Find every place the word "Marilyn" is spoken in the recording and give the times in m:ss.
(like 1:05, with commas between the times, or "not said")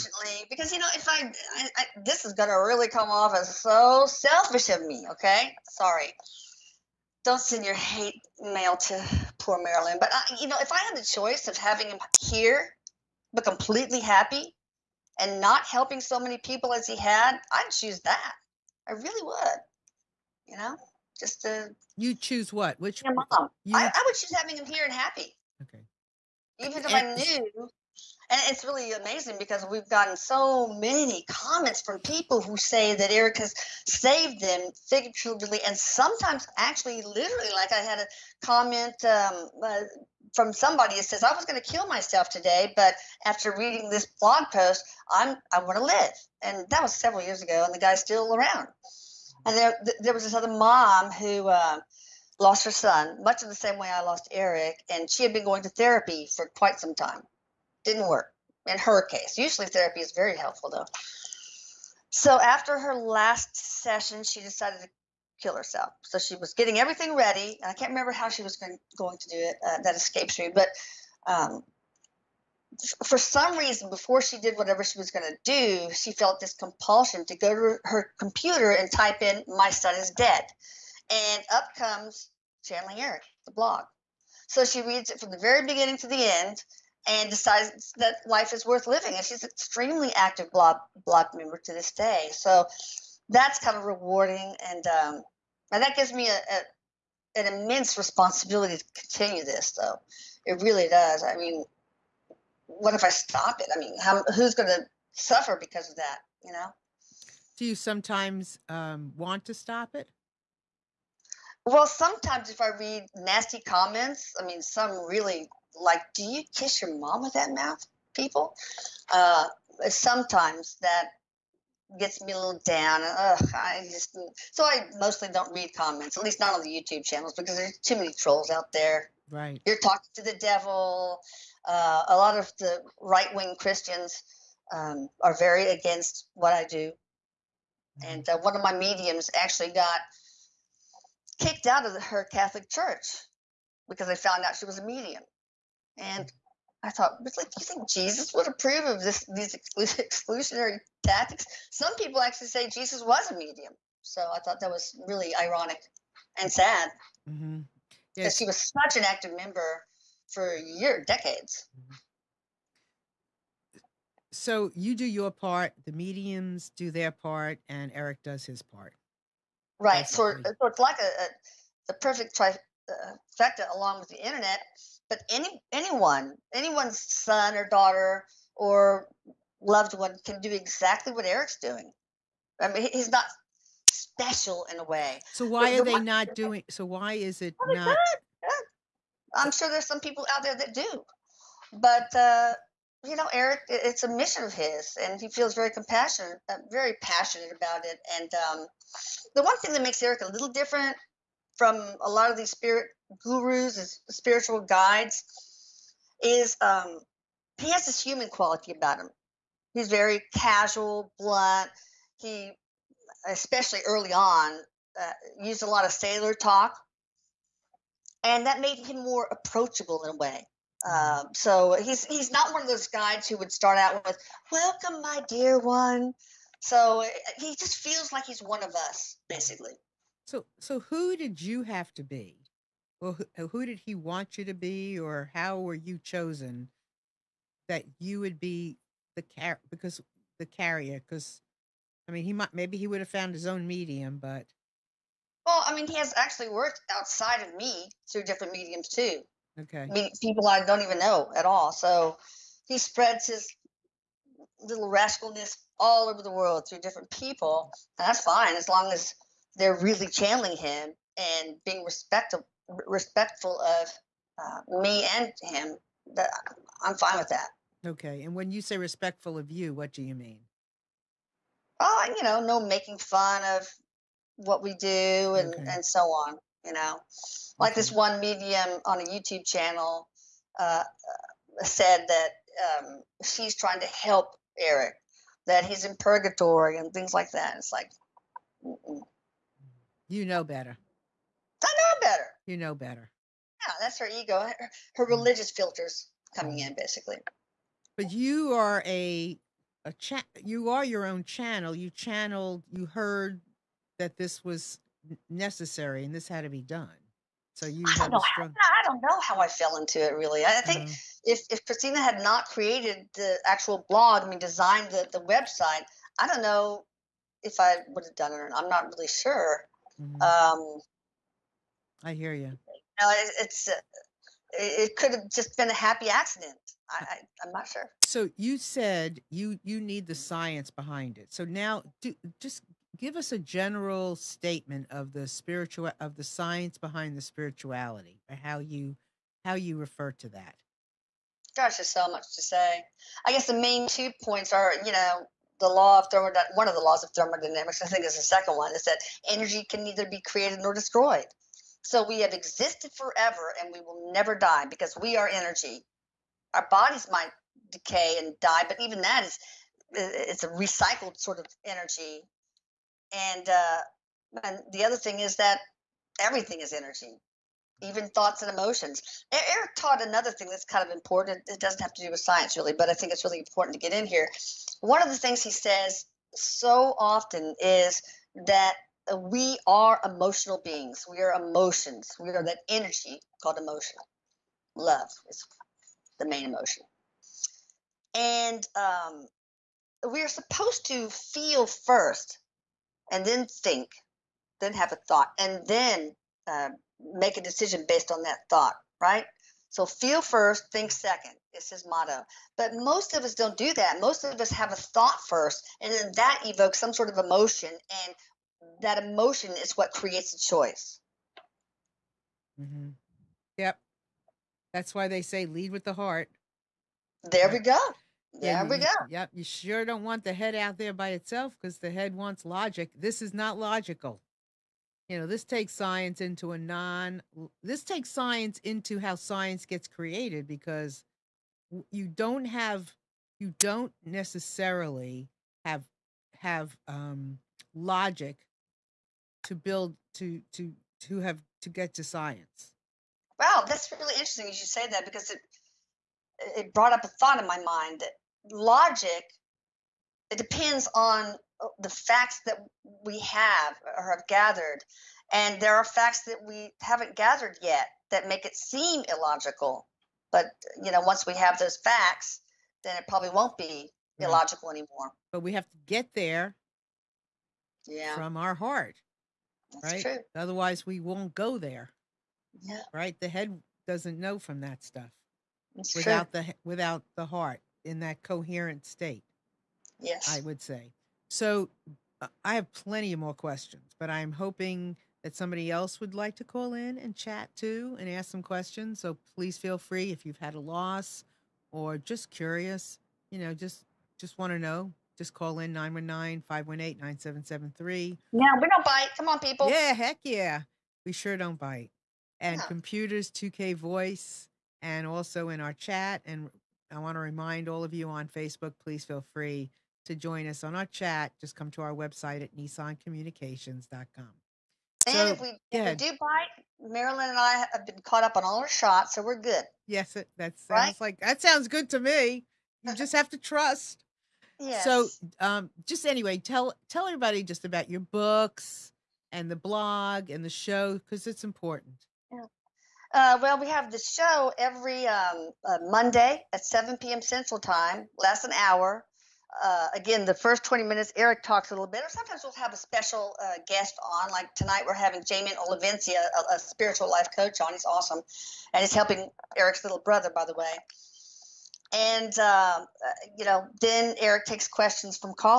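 0:09, 8:36.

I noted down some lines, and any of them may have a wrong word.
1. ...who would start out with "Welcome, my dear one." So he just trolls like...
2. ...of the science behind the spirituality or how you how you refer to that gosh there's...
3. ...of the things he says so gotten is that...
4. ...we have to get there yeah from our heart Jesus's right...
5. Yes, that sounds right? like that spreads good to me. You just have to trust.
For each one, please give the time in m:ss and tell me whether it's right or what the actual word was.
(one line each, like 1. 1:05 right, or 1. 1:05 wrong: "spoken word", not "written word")
1. 3:43 wrong: "feels", not "trolls"
2. 5:35 right
3. 6:15 wrong: "often", not "gotten"
4. 7:45 wrong: "That", not "Jesus"
5. 8:39 wrong: "sounds", not "spreads".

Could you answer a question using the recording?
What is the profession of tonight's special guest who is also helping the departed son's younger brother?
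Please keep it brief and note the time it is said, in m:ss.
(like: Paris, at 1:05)
Spiritual life coach, at 9:06.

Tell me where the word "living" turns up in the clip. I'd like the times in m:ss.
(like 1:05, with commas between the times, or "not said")
1:28.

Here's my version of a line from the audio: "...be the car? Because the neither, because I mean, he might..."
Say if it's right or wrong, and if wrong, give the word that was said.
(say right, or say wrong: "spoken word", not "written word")
wrong: "carrier", not "neither".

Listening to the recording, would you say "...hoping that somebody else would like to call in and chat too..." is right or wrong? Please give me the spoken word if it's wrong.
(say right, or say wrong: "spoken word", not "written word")
right.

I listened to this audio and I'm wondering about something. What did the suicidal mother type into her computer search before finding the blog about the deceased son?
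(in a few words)
My son is dead.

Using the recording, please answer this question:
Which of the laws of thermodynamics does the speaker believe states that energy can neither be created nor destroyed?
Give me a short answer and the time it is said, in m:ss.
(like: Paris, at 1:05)
The second one, at 5:48.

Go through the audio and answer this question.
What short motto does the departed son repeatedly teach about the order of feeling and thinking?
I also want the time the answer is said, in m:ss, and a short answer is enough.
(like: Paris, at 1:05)
Feel first, think second, at 6:39.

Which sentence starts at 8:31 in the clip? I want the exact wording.
Just come to our website at nissancommunications.com.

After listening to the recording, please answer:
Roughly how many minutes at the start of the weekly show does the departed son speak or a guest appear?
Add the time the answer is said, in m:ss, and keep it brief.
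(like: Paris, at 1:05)
20, at 9:00.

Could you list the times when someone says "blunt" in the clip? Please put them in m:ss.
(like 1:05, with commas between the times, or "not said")
3:31.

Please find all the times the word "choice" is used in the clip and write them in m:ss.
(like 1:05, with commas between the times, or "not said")
0:11, 6:50.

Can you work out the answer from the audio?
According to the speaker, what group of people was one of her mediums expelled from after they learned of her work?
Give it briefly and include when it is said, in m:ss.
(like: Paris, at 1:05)
Her Catholic church, at 2:22.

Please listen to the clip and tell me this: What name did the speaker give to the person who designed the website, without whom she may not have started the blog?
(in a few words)
Christina.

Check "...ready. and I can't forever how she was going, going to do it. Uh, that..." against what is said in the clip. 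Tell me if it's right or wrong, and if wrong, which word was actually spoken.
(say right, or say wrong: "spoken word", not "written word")
wrong: "remember", not "forever".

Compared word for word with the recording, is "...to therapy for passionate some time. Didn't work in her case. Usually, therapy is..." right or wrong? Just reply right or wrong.
wrong.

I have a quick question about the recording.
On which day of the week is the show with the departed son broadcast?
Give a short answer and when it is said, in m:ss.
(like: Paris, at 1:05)
Monday, at 8:55.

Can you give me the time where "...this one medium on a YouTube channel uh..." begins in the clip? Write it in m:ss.
4:37.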